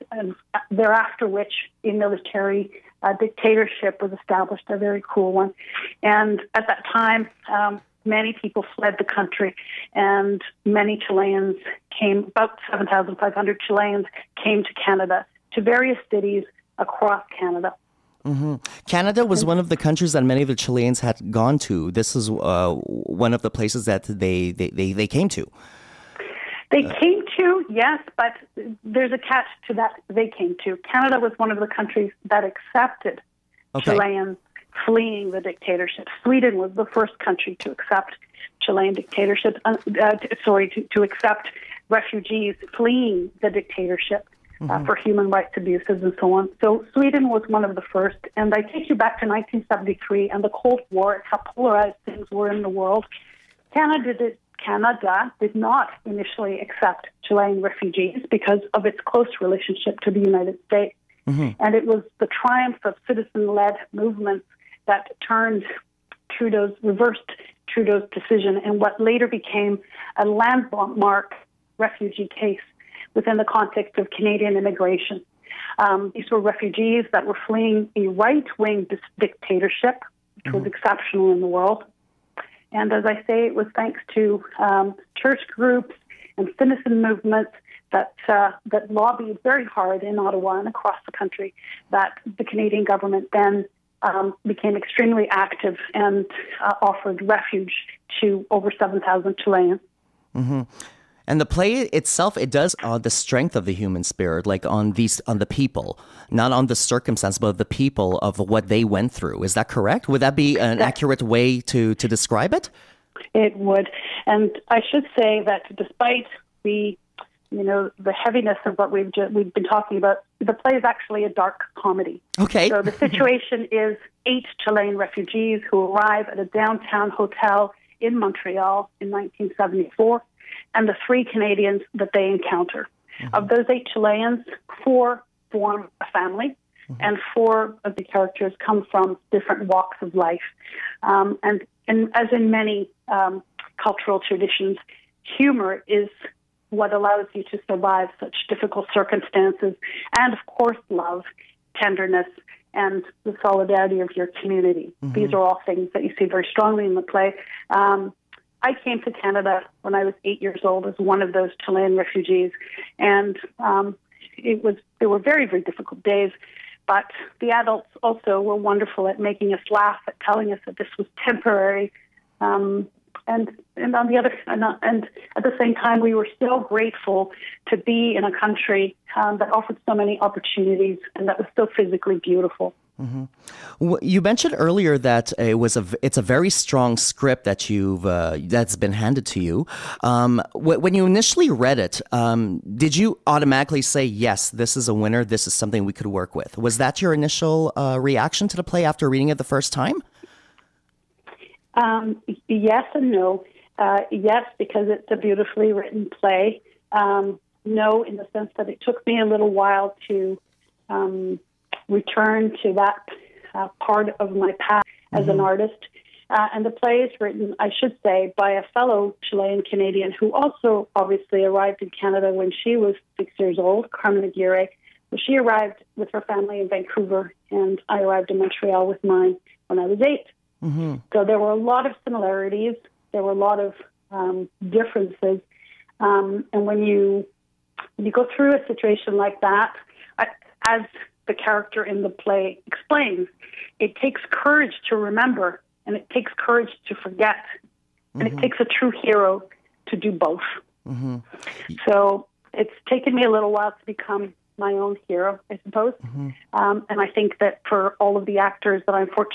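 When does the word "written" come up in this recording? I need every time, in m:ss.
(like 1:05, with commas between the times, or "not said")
3:25, 3:37.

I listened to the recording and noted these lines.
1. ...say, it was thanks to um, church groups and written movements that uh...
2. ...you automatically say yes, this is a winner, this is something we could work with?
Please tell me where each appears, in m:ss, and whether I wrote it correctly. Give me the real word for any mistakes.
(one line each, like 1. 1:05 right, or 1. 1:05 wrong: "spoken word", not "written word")
1. 1:23 wrong: "citizen", not "written"
2. 3:12 right.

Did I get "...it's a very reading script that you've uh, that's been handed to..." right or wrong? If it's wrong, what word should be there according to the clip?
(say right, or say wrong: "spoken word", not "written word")
wrong: "strong", not "reading".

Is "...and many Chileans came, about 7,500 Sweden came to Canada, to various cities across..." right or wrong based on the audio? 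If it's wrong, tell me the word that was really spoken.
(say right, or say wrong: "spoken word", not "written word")
wrong: "Chileans", not "Sweden".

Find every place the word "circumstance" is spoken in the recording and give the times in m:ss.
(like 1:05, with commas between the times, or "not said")
1:46, 2:28.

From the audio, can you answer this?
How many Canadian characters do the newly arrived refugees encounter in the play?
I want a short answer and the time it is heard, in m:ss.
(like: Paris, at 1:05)
3, at 2:11.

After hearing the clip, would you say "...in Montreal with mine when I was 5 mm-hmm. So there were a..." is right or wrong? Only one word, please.
wrong.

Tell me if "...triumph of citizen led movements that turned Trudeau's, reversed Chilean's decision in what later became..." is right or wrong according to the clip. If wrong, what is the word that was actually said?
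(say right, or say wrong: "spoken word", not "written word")
wrong: "Trudeau", not "Chilean".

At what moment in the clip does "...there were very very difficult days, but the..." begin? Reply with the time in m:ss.
2:44.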